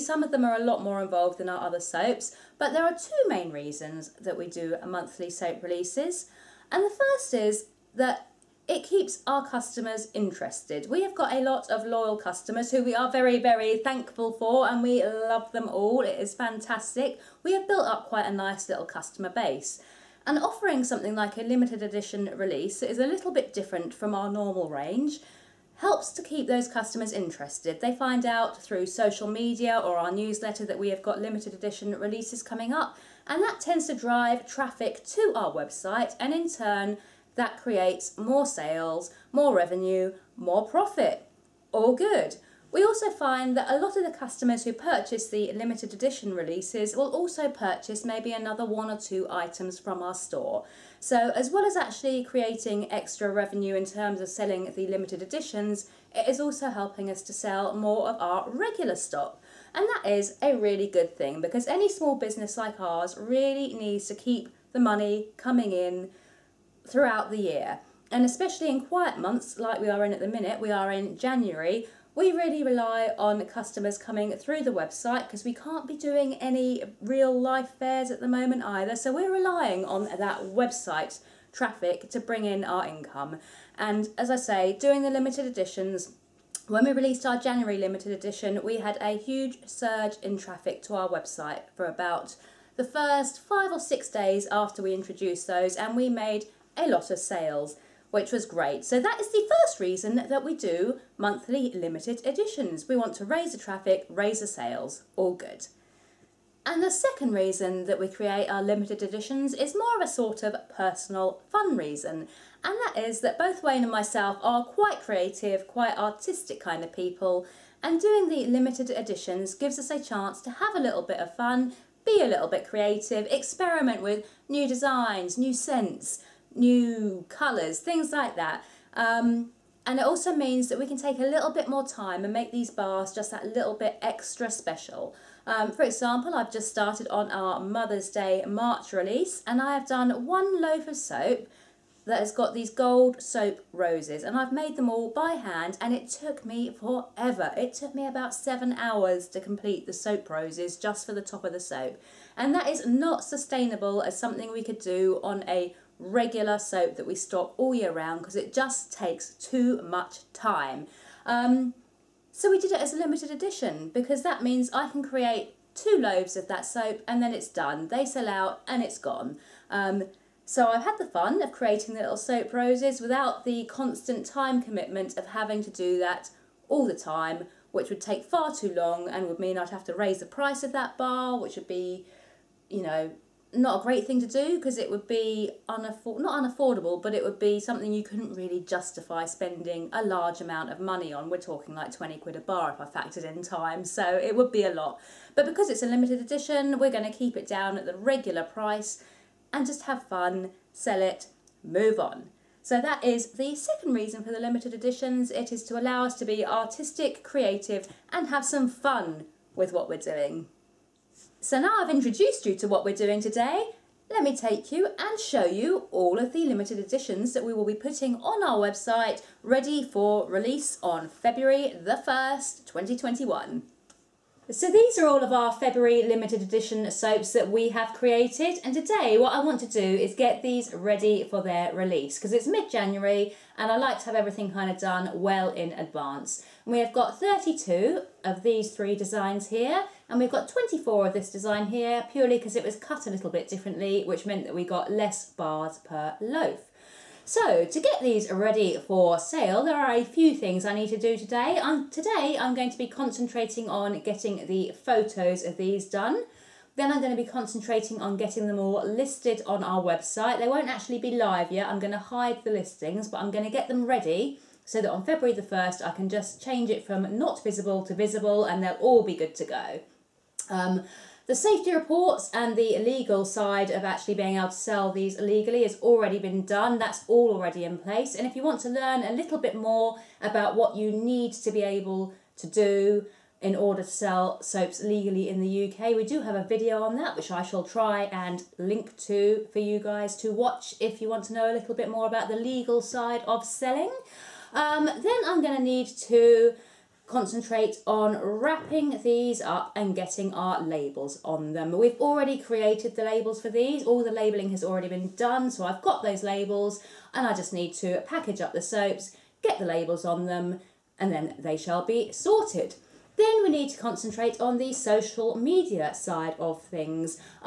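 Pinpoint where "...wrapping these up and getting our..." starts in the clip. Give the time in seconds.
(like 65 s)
298 s.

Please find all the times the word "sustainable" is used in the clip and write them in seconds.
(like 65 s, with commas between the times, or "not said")
153 s.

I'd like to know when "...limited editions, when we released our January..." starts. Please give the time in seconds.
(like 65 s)
85 s.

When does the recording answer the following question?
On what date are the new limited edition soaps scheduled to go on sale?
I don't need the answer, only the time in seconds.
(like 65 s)
221 s.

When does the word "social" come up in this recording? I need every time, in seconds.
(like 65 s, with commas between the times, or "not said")
28 s, 314 s.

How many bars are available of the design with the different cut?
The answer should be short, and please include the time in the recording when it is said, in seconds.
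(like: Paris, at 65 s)
24, at 240 s.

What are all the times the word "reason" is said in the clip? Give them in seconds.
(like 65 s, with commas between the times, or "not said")
3 s, 99 s, 107 s, 111 s, 203 s.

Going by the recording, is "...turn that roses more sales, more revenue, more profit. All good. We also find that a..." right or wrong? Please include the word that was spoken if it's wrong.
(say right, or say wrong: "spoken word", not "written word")
wrong: "creates", not "roses".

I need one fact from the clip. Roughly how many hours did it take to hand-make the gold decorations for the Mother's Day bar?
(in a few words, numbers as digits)
7.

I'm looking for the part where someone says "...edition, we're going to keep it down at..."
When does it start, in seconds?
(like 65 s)
196 s.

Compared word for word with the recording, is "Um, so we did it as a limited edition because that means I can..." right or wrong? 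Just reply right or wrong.
right.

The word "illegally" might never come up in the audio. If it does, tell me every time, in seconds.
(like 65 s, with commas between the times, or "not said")
275 s.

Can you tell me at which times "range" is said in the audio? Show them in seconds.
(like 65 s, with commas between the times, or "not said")
24 s.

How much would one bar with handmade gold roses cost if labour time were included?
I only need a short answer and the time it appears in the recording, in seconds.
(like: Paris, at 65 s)
20 quid, at 191 s.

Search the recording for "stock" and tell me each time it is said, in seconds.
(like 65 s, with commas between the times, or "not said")
58 s, 157 s.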